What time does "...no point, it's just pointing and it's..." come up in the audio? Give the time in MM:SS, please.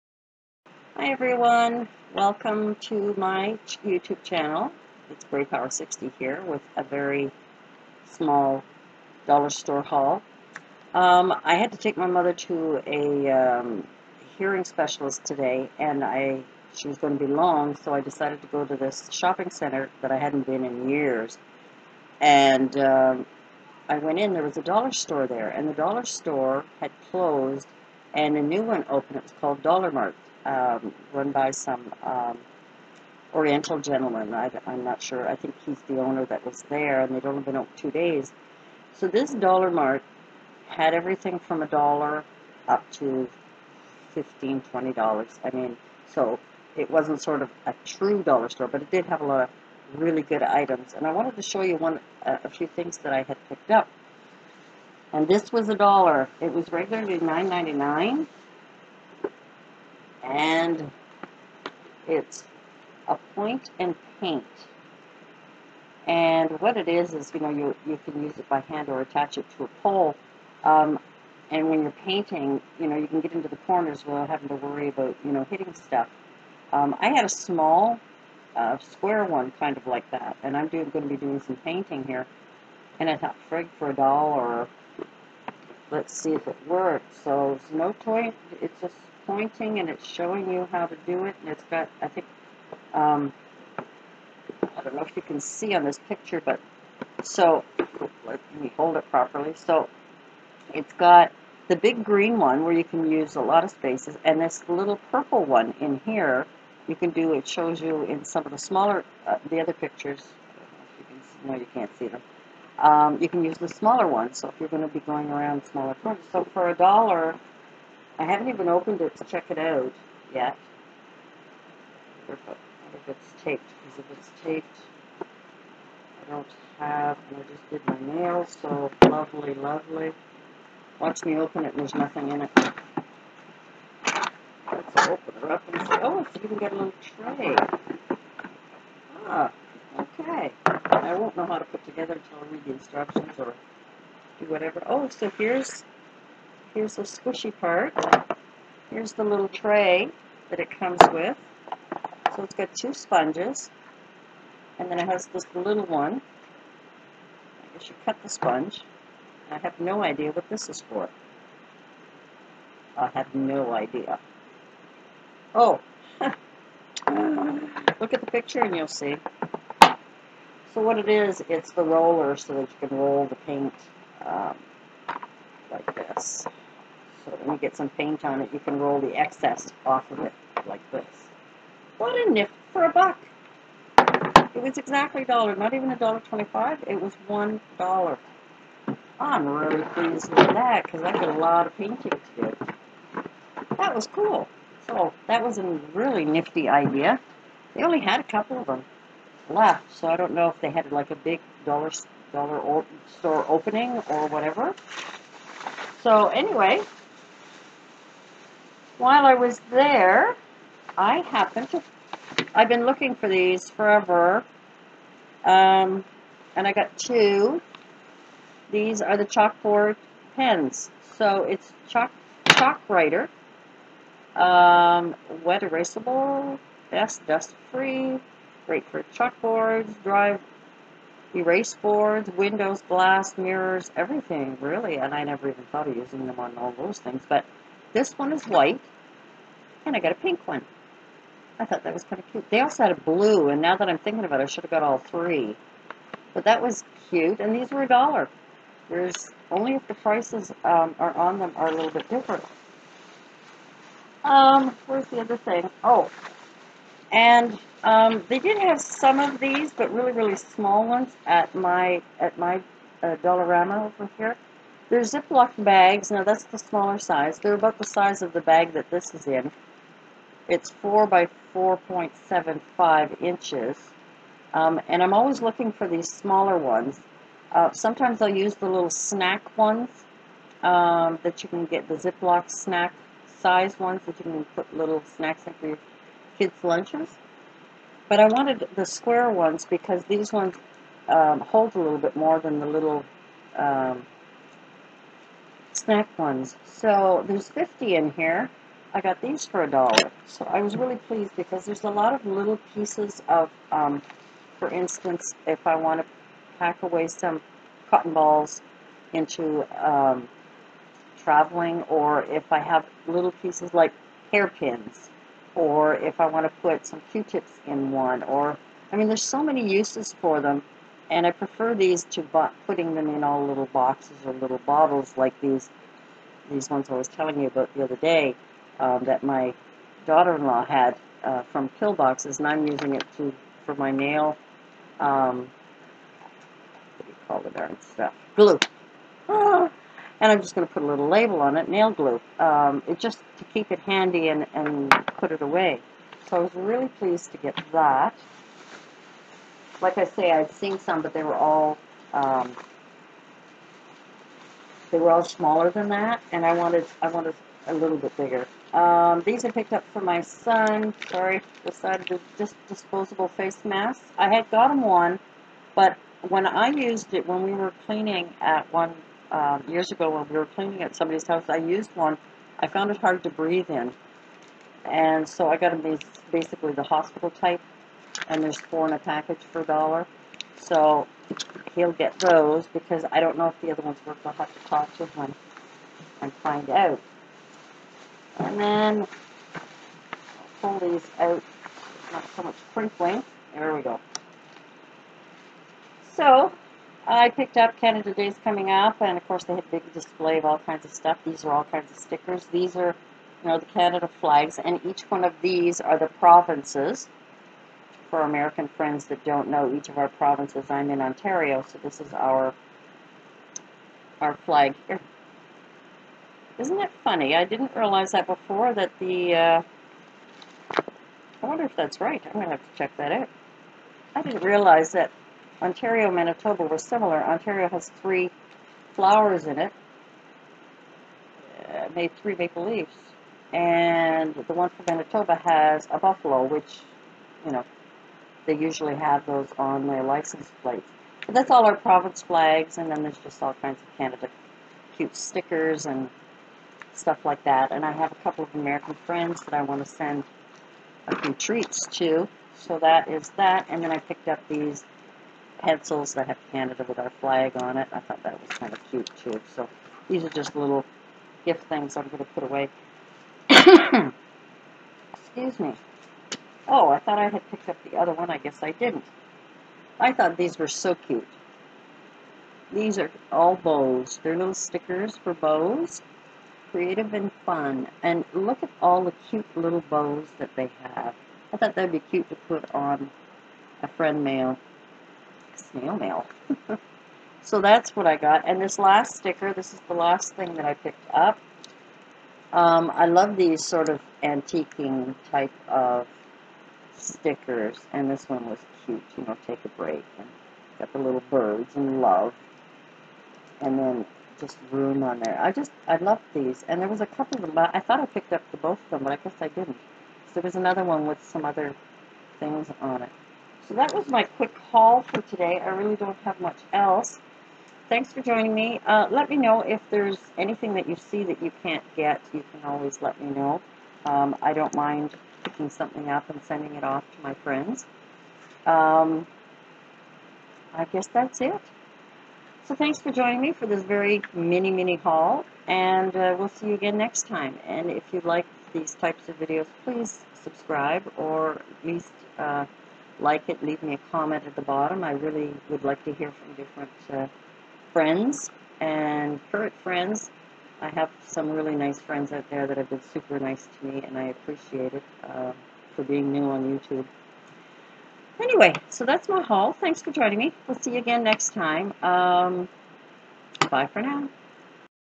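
01:27.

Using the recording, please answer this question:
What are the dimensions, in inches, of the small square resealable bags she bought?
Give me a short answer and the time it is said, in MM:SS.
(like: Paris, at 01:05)
4 by 4.75, at 04:30.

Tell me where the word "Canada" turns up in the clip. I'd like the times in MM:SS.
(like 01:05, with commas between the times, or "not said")
06:37, 06:43, 07:23, 07:36.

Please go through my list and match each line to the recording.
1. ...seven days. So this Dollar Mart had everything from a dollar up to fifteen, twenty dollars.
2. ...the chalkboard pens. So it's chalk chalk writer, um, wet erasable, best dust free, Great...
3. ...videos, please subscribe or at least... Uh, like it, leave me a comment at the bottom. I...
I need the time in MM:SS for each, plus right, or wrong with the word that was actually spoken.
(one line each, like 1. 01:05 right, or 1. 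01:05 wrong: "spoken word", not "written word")
1. 00:37 wrong: "two", not "seven"
2. 03:39 right
3. 08:59 right.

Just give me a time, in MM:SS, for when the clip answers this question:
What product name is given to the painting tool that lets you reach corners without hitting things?
01:03.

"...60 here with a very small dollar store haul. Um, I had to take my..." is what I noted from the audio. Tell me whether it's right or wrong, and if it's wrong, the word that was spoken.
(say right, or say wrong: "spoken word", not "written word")
right.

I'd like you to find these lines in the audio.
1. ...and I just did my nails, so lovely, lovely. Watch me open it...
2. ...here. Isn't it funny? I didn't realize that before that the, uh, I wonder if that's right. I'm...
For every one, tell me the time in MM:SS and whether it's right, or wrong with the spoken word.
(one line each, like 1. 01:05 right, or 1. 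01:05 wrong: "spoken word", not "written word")
1. 02:07 right
2. 06:54 right.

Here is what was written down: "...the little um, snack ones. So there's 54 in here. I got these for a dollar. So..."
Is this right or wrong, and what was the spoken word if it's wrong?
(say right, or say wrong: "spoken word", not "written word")
wrong: "50", not "54".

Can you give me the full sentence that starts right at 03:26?
So anyway, while I was there, I happened to I've been looking for these forever.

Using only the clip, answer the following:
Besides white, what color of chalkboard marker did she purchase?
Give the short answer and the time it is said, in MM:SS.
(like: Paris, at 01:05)
pink, at 04:00.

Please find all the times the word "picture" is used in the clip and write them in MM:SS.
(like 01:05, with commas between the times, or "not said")
01:36, 01:49, 02:48.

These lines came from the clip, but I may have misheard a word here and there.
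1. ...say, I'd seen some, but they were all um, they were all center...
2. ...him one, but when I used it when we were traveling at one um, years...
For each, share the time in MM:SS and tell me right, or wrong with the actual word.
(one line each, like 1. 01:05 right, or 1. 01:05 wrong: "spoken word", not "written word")
1. 05:50 wrong: "smaller", not "center"
2. 06:04 wrong: "cleaning", not "traveling".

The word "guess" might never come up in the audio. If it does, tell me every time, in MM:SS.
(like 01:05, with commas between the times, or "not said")
02:37, 07:48, 08:29, 08:50.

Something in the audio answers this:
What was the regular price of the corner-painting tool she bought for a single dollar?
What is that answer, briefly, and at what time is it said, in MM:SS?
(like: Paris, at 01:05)
9.99, at 00:57.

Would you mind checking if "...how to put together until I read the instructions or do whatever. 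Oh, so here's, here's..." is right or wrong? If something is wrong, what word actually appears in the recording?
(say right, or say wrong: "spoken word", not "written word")
right.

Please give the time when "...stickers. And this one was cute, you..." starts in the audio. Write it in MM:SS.
08:16.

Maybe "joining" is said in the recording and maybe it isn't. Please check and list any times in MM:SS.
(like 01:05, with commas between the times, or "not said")
08:38, 08:53, 09:20.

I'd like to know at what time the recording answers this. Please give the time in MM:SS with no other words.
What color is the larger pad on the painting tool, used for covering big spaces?
01:42.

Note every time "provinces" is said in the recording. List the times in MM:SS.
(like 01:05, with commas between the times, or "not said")
06:46, 06:50, 07:21.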